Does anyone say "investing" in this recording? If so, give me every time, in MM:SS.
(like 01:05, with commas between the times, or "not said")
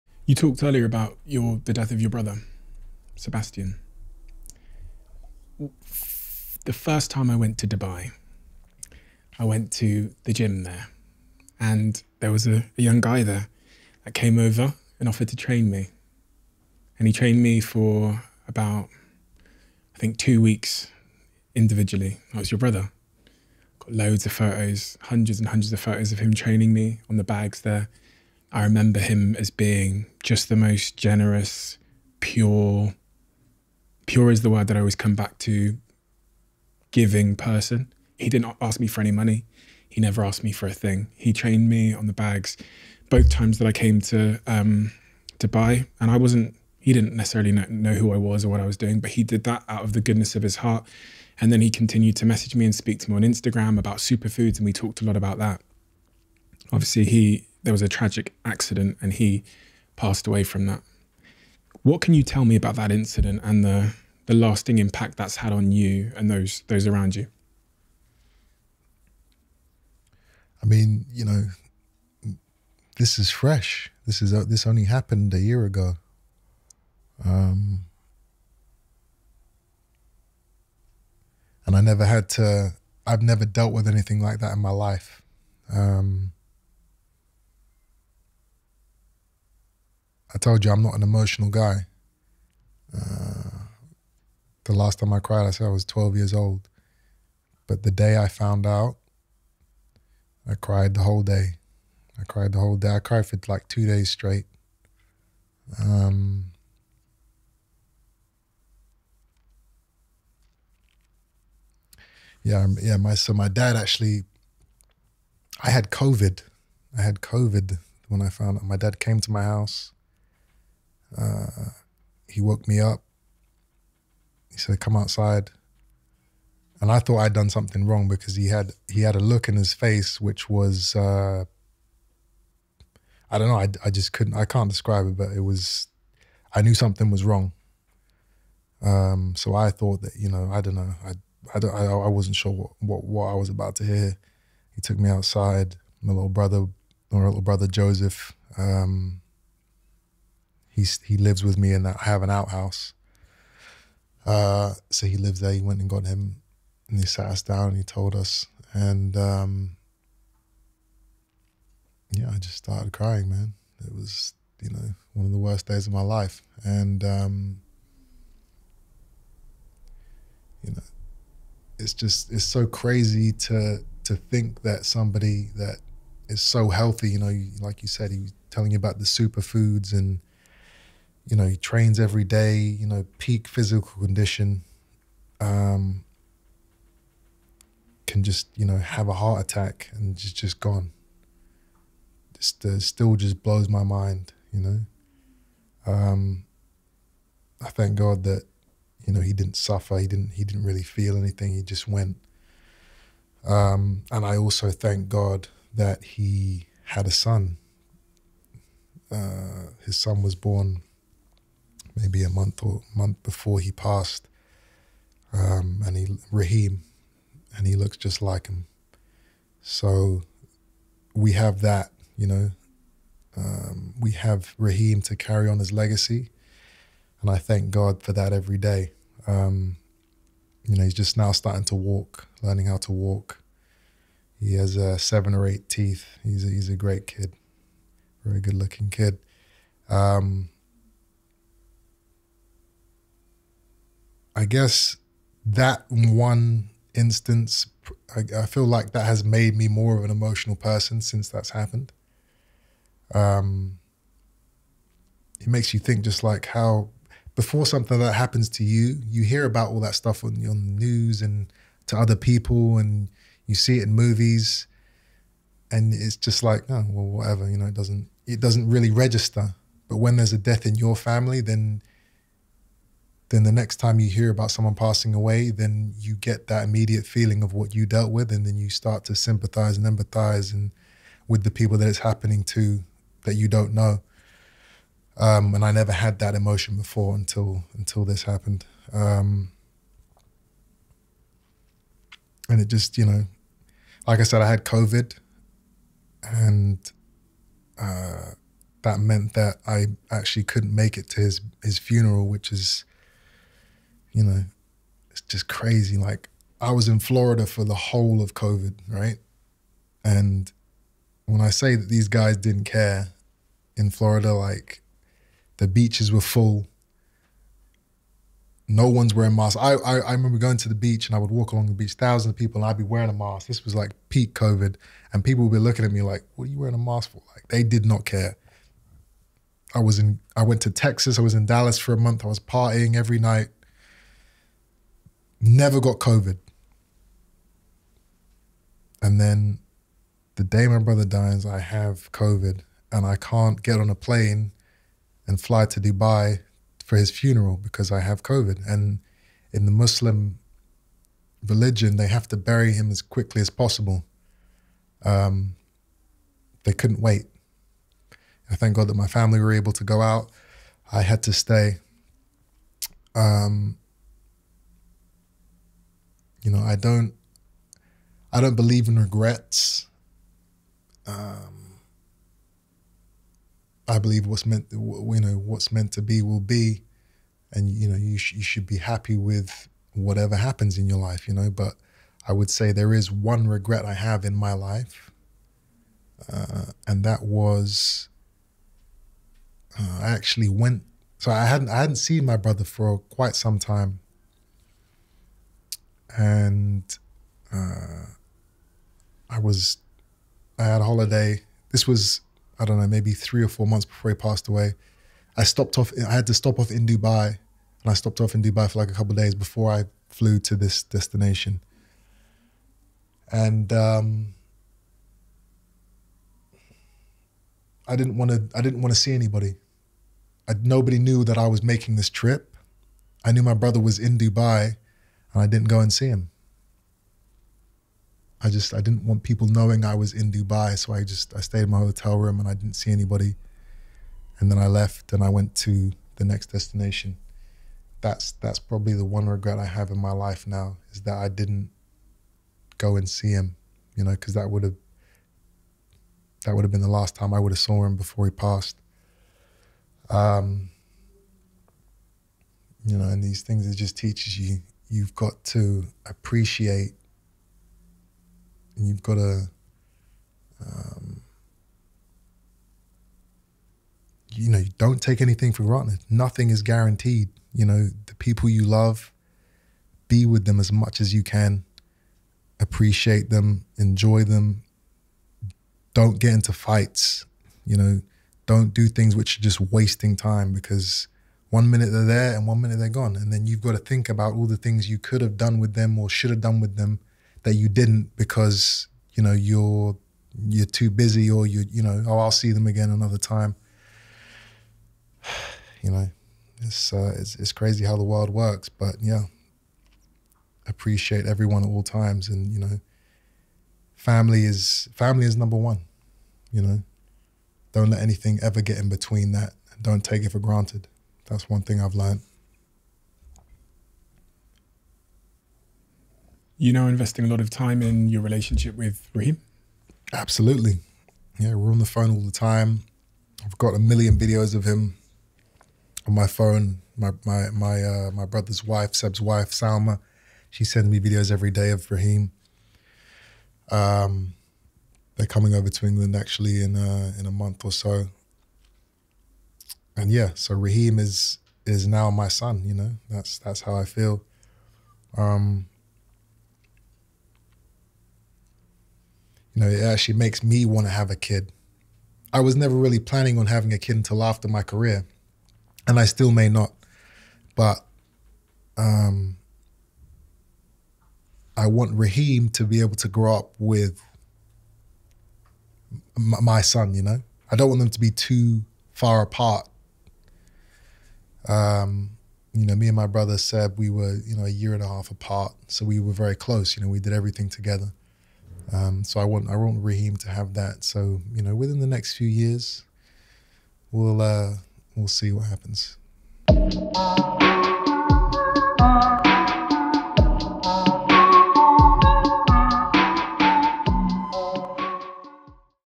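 08:36.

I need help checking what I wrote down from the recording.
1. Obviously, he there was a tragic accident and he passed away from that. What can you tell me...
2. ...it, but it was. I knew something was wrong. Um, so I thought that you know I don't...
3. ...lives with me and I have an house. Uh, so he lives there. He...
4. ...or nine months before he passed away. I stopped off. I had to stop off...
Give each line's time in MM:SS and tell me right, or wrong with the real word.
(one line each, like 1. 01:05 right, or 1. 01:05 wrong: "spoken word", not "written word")
1. 00:56 right
2. 02:15 right
3. 02:31 wrong: "outhouse", not "house"
4. 06:43 wrong: "four", not "nine".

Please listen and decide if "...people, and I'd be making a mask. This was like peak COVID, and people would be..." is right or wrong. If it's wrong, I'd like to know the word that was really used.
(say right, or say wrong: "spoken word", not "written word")
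wrong: "wearing", not "making".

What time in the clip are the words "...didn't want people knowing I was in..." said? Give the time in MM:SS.
07:08.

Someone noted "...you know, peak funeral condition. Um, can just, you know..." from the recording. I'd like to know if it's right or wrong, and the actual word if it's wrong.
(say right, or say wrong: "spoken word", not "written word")
wrong: "physical", not "funeral".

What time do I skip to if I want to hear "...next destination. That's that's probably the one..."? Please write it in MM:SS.
07:16.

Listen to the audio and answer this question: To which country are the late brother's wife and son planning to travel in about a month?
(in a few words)
England.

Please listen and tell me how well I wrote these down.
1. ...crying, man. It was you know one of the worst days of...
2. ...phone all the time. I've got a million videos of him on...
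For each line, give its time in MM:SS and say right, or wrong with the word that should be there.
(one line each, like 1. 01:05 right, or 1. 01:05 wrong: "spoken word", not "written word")
1. 02:42 right
2. 08:41 right.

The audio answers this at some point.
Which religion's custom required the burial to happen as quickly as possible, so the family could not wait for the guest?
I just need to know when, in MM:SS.
05:49.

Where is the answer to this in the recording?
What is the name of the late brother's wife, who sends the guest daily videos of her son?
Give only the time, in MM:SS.
08:49.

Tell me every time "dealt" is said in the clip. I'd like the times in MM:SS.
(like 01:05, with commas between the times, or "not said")
01:23, 04:37.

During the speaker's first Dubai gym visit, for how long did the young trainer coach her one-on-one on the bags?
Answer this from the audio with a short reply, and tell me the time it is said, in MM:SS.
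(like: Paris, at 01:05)
2 weeks, at 00:20.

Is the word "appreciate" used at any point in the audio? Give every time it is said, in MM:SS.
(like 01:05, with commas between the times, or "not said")
07:36, 07:52, 08:20.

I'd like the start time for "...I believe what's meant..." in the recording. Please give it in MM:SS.
06:13.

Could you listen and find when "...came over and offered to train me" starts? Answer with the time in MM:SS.
00:14.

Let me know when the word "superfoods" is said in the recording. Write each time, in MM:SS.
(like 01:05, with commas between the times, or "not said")
00:53, 02:59.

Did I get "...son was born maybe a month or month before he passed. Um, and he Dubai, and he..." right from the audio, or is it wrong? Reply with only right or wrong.
wrong.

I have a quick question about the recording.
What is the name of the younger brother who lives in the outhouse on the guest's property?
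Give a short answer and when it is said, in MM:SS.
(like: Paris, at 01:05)
Joseph, at 02:27.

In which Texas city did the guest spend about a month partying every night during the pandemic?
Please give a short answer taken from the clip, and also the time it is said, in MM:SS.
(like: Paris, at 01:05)
Dallas, at 05:31.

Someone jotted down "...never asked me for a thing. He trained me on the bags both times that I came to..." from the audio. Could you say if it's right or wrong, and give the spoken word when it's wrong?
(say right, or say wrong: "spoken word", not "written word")
right.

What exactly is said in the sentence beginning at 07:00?
I, nobody knew that I was making this trip.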